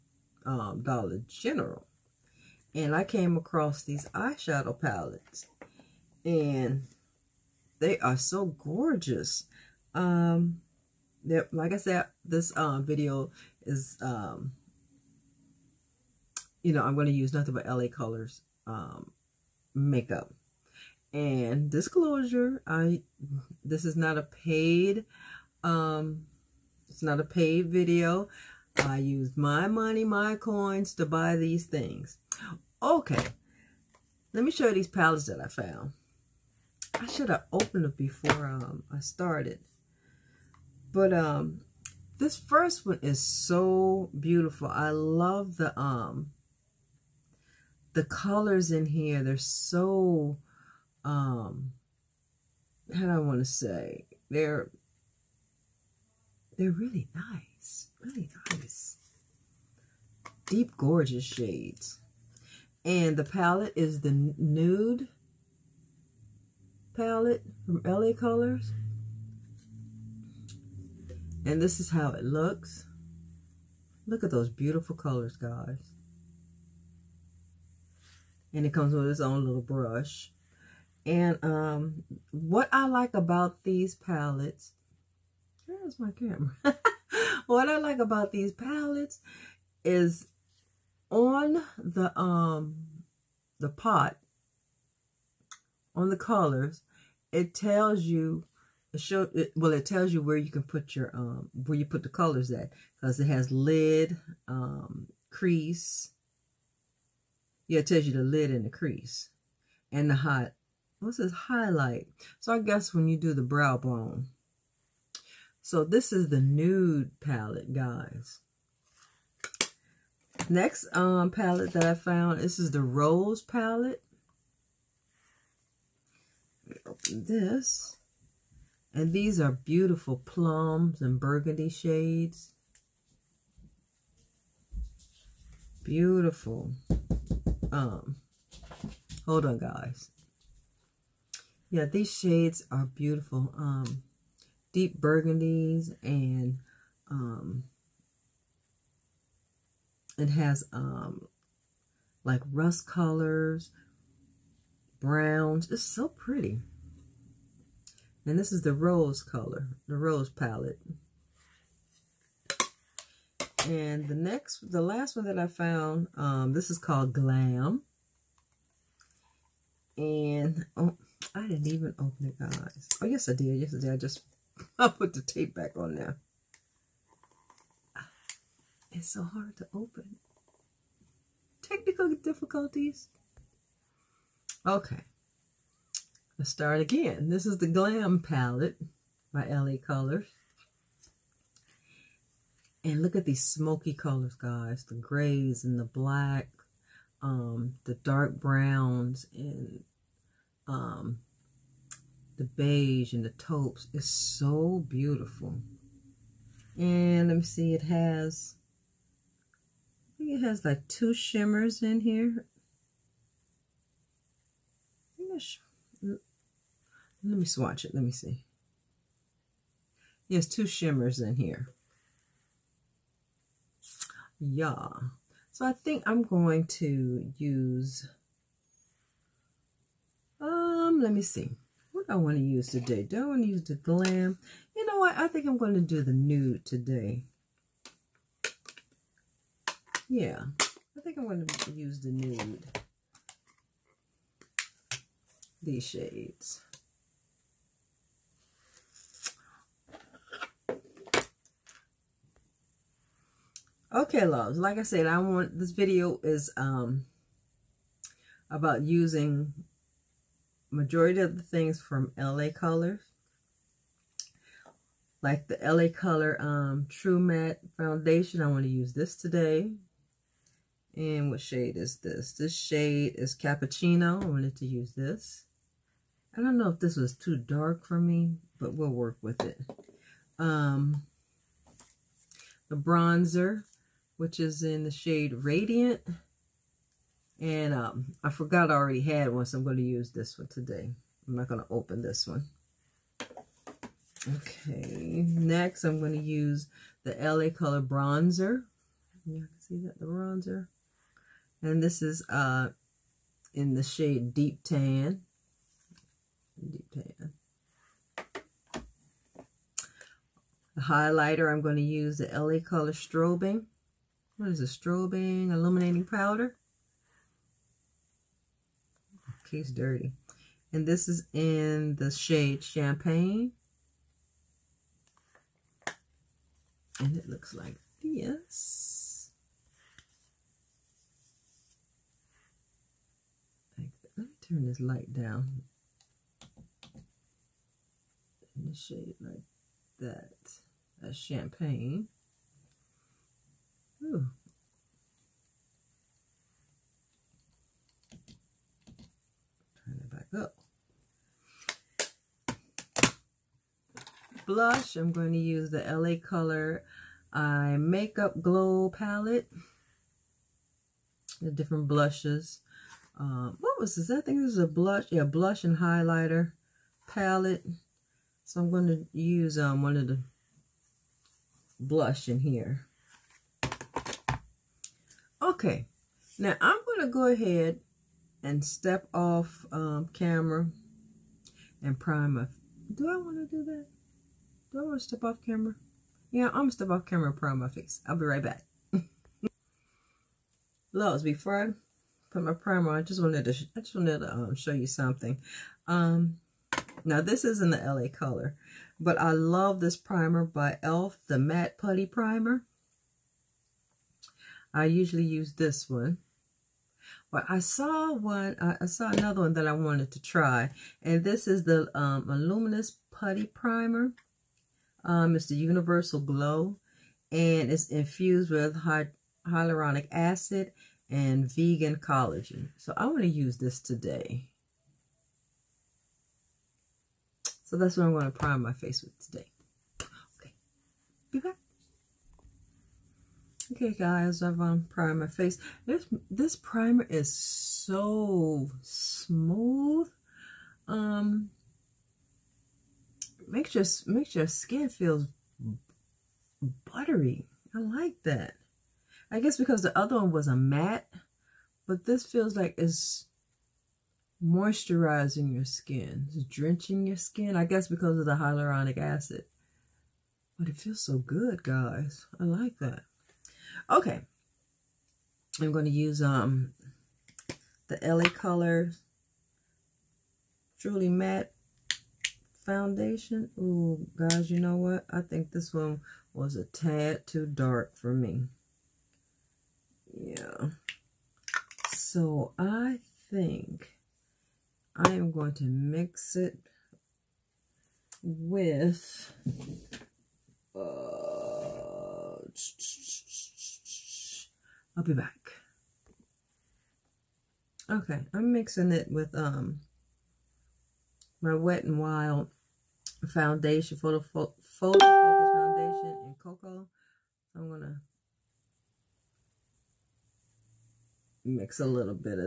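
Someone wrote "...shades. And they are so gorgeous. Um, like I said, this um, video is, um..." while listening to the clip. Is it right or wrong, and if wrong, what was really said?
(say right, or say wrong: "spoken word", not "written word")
wrong: "palettes", not "shades".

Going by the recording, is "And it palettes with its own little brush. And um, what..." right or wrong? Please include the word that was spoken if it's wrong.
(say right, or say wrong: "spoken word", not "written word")
wrong: "comes", not "palettes".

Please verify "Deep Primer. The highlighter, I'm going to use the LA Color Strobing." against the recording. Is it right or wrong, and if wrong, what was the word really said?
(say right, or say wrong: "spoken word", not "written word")
wrong: "Tan", not "Primer".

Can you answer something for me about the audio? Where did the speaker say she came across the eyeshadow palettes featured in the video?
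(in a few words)
Dollar General.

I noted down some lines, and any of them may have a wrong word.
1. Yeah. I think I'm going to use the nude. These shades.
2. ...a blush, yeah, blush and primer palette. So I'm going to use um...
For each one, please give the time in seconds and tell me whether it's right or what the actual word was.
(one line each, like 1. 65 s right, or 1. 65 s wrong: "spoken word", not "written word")
1. 240 s right
2. 364 s wrong: "highlighter", not "primer".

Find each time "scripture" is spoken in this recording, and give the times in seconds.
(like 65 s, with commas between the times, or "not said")
not said.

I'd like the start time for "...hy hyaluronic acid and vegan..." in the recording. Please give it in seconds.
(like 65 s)
418 s.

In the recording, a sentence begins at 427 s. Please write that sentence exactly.
So that's what I'm going to prime my face with today.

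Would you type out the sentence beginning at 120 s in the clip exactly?
Next um, palette that I found, this is the Rose palette.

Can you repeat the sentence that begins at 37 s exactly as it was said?
I should have opened it before um, I started.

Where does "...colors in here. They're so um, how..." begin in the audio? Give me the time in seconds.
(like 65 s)
48 s.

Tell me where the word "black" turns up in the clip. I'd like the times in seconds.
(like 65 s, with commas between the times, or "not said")
195 s.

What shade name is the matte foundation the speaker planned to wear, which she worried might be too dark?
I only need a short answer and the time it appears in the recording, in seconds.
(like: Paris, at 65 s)
Cappuccino, at 273 s.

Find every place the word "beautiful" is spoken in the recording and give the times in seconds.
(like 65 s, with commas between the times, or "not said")
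44 s, 74 s, 129 s, 135 s, 142 s, 204 s.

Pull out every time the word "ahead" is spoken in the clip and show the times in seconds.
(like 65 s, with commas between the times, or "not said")
377 s.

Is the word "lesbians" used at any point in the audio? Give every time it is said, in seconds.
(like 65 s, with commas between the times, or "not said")
not said.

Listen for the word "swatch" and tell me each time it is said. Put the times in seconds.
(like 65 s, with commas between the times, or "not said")
217 s.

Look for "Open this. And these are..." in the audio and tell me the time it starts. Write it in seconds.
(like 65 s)
126 s.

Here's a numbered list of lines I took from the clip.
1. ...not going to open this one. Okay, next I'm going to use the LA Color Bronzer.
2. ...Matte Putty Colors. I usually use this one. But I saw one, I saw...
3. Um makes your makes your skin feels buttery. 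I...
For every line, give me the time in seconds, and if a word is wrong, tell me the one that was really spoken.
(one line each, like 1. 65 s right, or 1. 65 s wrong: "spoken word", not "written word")
1. 291 s right
2. 401 s wrong: "Primer", not "Colors"
3. 440 s right.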